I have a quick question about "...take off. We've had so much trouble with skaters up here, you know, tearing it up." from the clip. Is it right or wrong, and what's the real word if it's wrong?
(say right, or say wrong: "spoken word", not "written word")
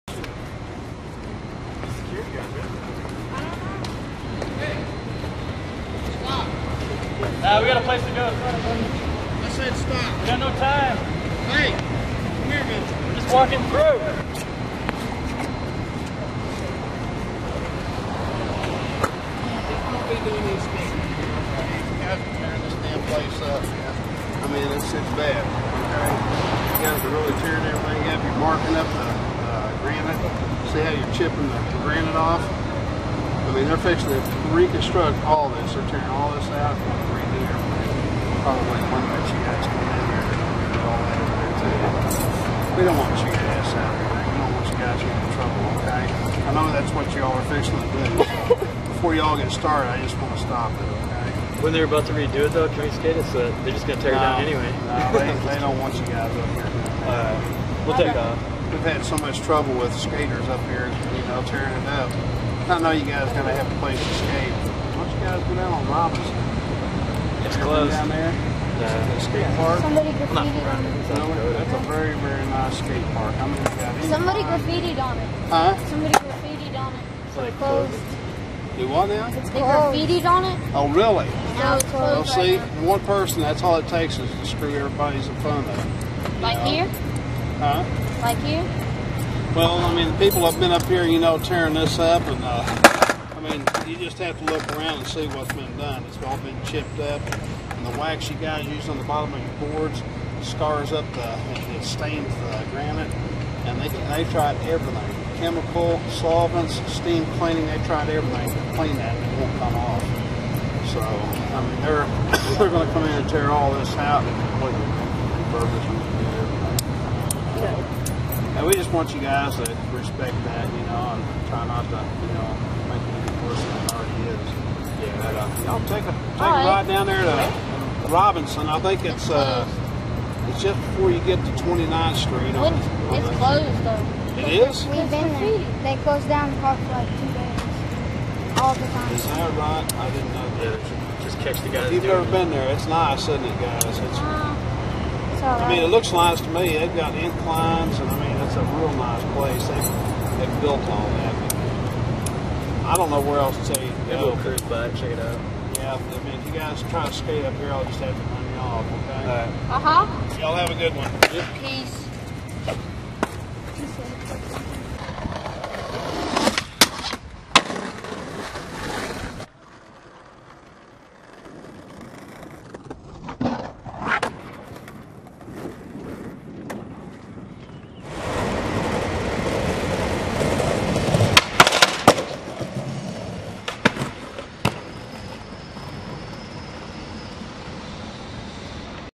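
right.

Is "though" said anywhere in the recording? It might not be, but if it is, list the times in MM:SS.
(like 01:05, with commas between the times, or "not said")
00:52, 02:13.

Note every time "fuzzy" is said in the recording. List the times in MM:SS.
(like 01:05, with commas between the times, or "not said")
not said.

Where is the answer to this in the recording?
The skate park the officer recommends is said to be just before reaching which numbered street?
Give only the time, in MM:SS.
02:11.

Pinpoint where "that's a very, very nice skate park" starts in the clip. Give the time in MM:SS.
01:11.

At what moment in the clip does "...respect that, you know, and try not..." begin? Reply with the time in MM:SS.
01:59.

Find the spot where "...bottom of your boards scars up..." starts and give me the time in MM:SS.
01:39.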